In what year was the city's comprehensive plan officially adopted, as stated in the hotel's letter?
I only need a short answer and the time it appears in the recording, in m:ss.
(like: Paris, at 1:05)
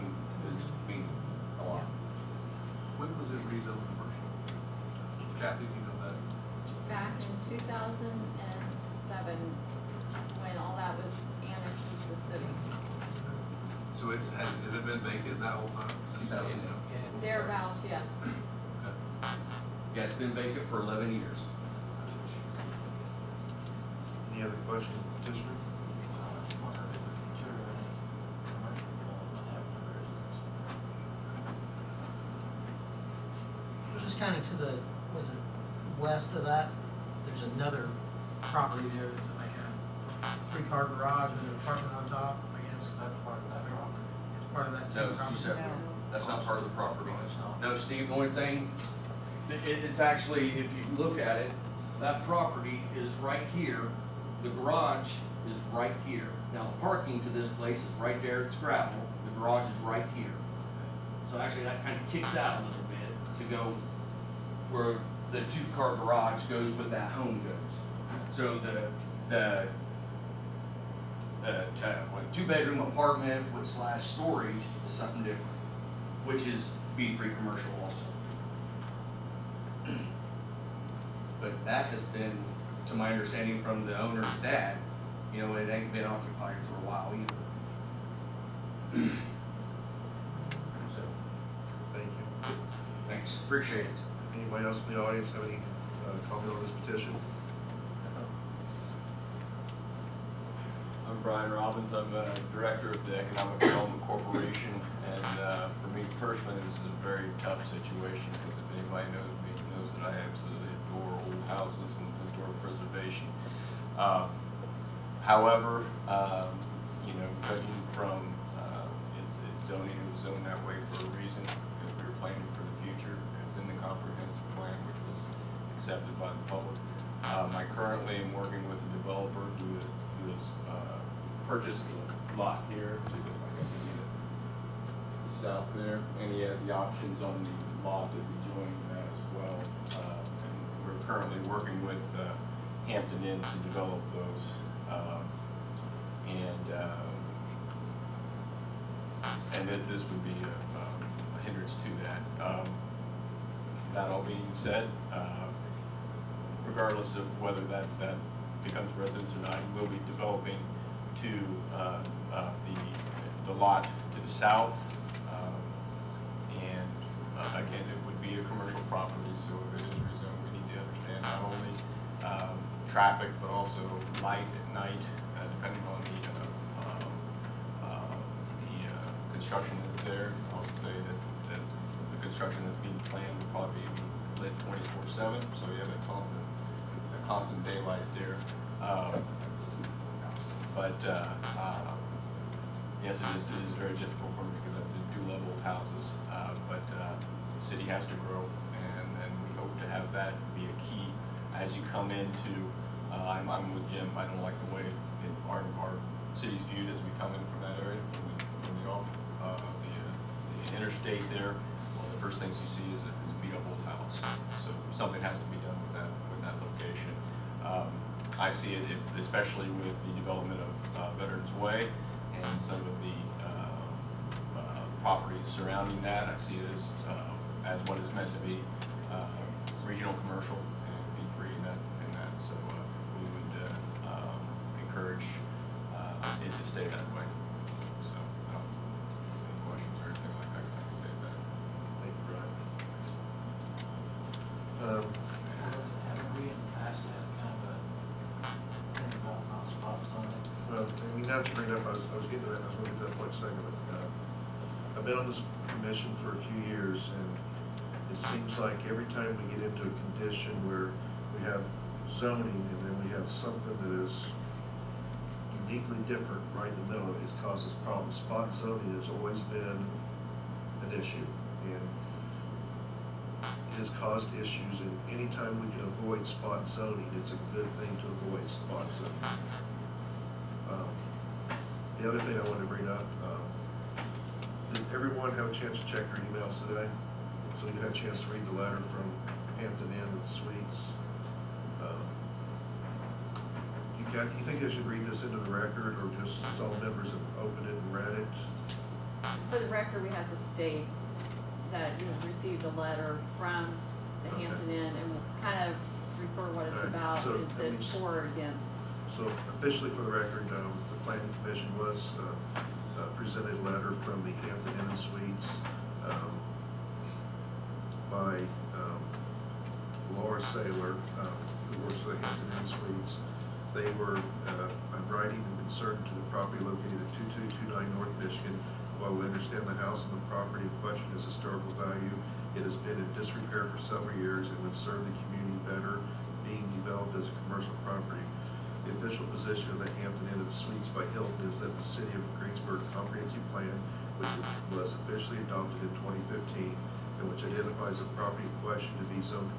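2015, at 5:46.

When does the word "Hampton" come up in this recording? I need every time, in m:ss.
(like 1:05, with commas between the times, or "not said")
2:22, 4:49, 5:04, 5:14, 5:22, 5:40.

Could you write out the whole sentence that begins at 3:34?
So something has to be done with that with that location.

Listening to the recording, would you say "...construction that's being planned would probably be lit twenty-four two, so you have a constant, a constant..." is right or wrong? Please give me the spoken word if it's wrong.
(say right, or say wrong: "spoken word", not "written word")
wrong: "seven", not "two".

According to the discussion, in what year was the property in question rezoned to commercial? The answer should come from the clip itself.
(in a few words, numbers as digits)
2007.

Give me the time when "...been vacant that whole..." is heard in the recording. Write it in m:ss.
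0:14.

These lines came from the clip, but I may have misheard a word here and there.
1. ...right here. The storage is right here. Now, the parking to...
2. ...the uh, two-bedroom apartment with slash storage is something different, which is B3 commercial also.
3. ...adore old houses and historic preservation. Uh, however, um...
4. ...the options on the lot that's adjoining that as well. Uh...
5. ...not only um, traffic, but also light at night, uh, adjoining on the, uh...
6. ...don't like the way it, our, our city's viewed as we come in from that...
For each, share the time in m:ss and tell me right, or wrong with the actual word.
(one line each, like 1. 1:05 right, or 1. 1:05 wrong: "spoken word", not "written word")
1. 0:53 wrong: "garage", not "storage"
2. 1:09 right
3. 1:50 right
4. 2:16 right
5. 2:51 wrong: "depending", not "adjoining"
6. 3:24 right.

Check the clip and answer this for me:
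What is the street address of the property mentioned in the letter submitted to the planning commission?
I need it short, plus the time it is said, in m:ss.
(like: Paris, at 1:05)
2229 North Michigan, at 5:27.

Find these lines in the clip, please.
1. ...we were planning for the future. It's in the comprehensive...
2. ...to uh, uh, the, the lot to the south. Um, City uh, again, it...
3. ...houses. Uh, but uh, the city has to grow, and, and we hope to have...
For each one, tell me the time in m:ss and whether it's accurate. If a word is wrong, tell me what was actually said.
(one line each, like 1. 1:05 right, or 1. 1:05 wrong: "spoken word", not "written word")
1. 2:01 right
2. 2:41 wrong: "And", not "City"
3. 3:15 right.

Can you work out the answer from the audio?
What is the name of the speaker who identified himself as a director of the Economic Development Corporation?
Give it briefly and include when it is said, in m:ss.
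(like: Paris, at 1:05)
Brian Robbins, at 1:41.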